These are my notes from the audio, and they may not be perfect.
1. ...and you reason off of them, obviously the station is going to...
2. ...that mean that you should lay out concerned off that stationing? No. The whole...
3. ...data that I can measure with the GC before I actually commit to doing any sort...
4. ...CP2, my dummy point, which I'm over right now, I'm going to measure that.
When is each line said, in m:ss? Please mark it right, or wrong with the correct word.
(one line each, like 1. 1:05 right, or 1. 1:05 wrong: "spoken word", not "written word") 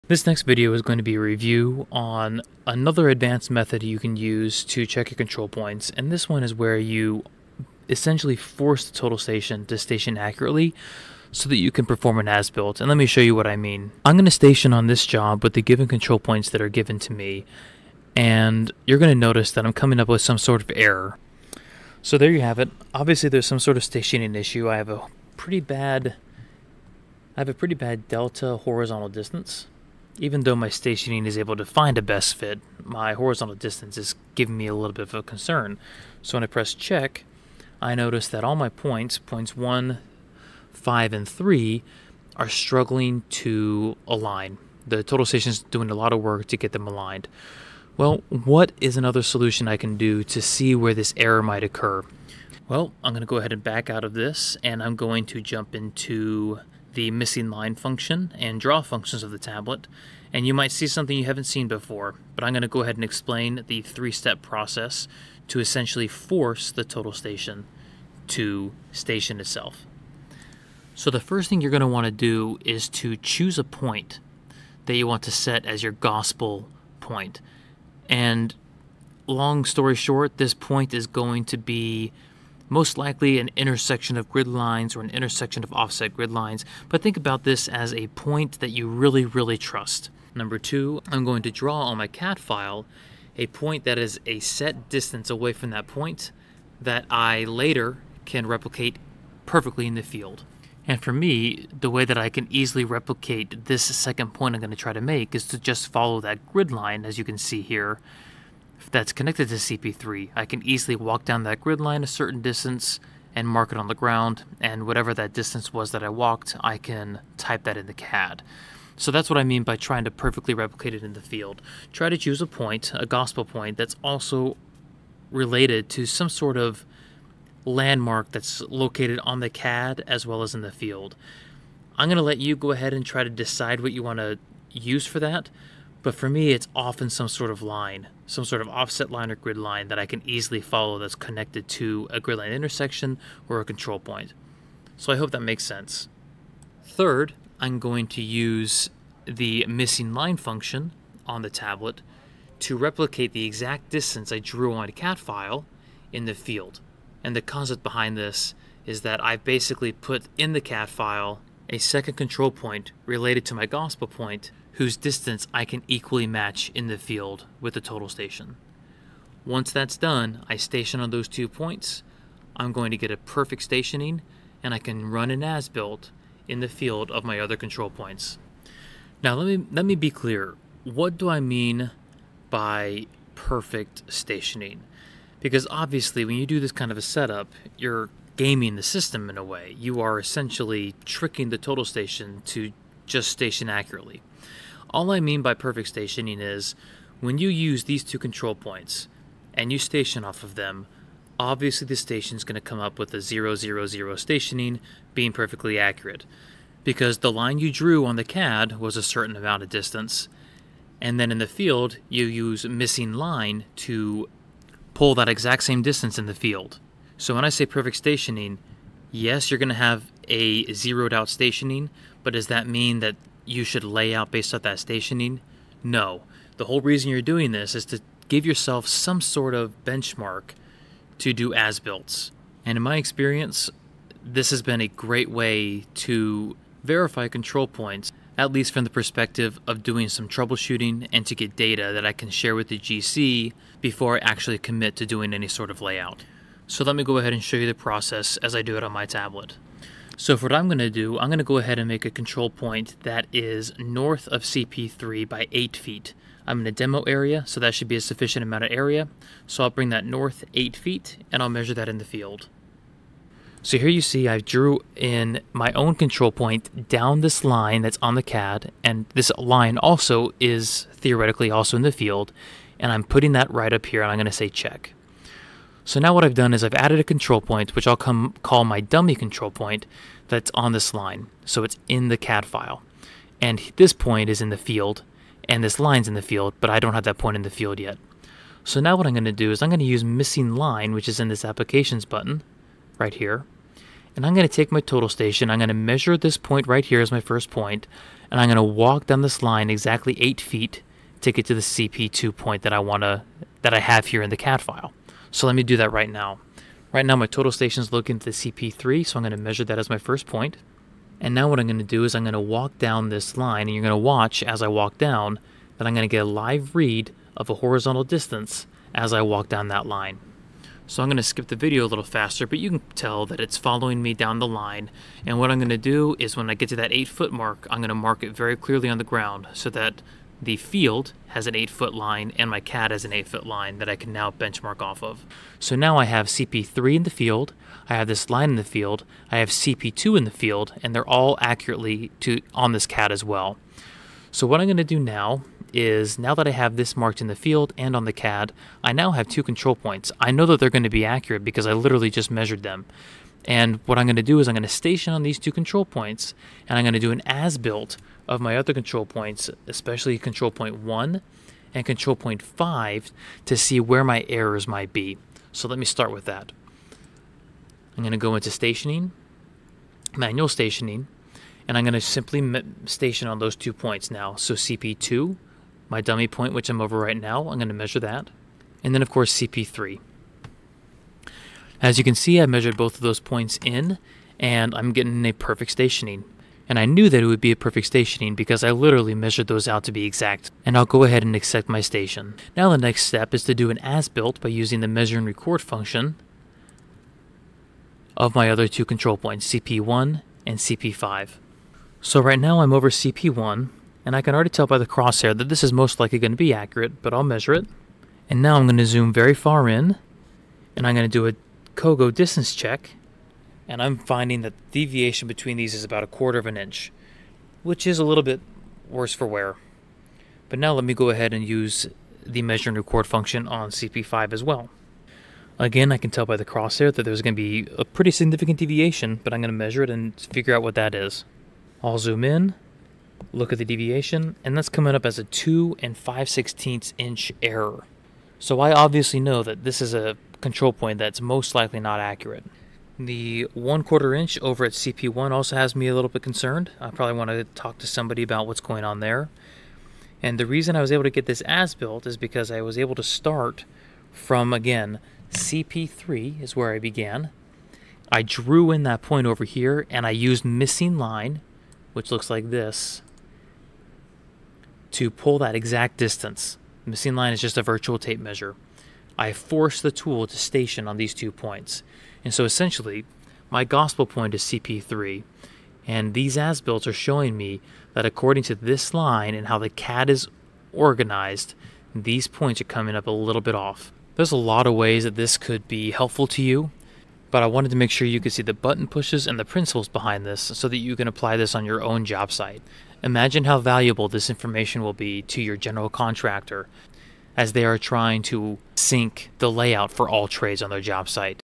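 1. 3:19 wrong: "station", not "reason"
2. 3:42 wrong: "based", not "concerned"
3. 4:01 wrong: "share", not "measure"
4. 6:14 right.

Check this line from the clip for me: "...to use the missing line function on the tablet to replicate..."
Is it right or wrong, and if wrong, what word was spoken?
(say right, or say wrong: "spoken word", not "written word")
right.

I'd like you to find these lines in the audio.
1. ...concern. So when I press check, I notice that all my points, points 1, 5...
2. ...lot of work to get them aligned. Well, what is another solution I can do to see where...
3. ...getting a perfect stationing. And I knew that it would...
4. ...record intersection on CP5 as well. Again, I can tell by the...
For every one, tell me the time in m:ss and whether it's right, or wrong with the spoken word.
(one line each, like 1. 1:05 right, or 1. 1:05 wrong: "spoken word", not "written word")
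1. 0:35 right
2. 0:45 right
3. 6:24 right
4. 7:02 wrong: "function", not "intersection".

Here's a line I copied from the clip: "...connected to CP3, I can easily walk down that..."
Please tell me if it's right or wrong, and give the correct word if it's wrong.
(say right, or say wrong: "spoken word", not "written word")
right.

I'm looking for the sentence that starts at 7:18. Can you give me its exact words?
So I obviously know that this is a control point that's most likely not accurate.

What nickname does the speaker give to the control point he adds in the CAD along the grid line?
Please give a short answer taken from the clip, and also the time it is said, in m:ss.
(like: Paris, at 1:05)
dummy control point, at 4:38.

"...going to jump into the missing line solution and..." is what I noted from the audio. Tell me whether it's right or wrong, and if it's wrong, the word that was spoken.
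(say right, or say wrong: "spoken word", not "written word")
wrong: "function", not "solution".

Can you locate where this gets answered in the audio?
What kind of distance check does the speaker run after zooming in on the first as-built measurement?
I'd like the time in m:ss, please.
6:51.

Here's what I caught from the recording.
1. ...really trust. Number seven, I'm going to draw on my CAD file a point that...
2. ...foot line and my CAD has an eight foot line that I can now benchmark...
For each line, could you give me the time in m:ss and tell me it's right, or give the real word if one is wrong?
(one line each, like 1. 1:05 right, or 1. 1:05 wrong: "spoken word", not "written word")
1. 1:29 wrong: "two", not "seven"
2. 5:31 right.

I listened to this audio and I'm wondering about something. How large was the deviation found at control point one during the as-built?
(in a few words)
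1/4 inch.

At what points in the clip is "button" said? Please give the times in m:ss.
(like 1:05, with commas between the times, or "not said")
4:52, 8:08.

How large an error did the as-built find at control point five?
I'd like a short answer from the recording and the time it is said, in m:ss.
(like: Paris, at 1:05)
2 5/16 inches, at 7:15.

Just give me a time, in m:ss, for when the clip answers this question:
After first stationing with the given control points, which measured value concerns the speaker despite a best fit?
0:28.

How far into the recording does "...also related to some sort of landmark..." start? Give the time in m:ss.
2:04.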